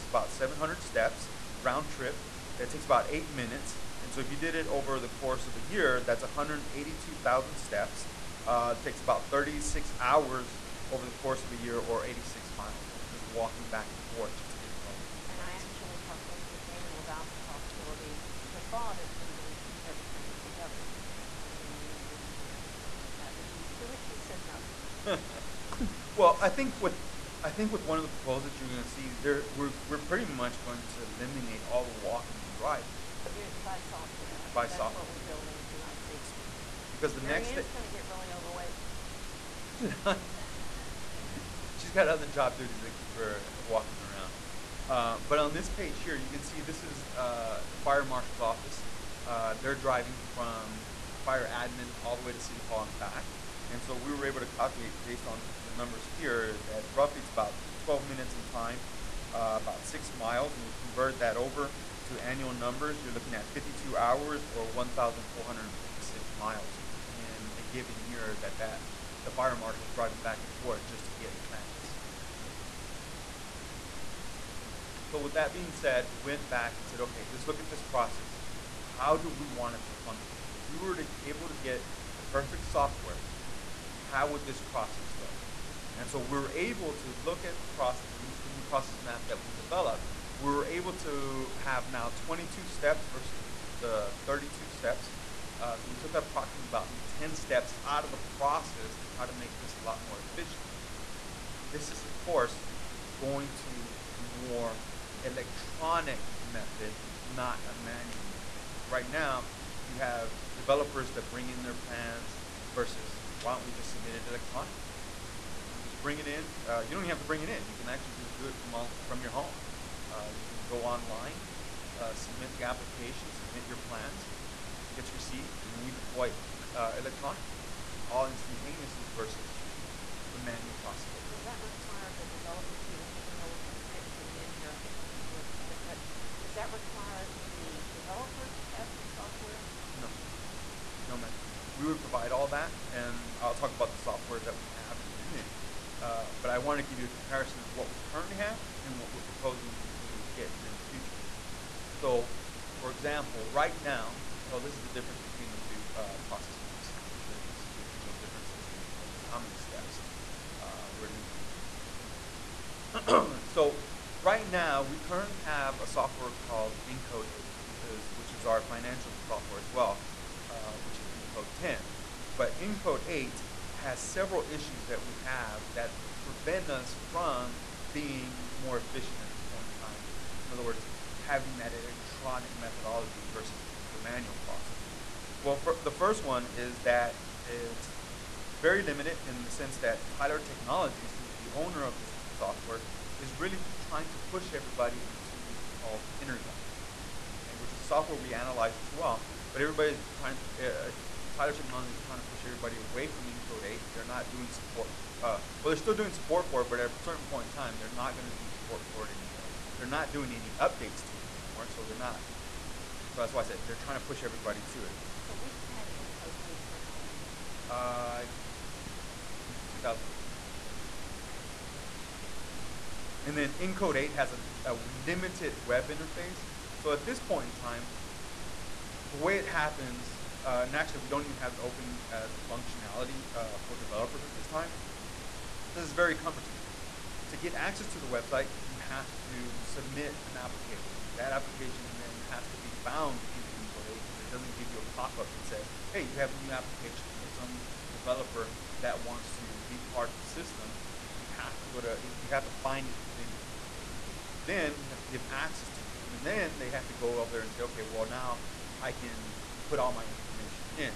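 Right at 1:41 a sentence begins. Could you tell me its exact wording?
This is, of course, going to a more electronic method, not a manual method.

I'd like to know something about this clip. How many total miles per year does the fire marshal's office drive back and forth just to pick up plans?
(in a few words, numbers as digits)
1,456 miles.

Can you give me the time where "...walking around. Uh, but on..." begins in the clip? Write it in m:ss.
0:43.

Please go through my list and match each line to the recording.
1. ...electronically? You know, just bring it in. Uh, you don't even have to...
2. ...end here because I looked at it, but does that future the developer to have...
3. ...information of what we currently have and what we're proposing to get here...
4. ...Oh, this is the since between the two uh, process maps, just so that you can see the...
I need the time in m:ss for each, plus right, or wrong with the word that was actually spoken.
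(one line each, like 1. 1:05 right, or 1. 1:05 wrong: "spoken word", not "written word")
1. 1:54 right
2. 2:14 wrong: "require", not "future"
3. 2:27 wrong: "comparison", not "information"
4. 2:34 wrong: "difference", not "since".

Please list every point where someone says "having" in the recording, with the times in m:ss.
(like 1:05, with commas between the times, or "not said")
3:01.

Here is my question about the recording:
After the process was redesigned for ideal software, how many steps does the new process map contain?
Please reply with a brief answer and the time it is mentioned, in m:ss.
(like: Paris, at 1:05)
22, at 1:32.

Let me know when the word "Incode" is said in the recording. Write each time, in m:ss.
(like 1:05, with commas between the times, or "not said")
3:23, 3:35, 3:43, 4:03, 4:13.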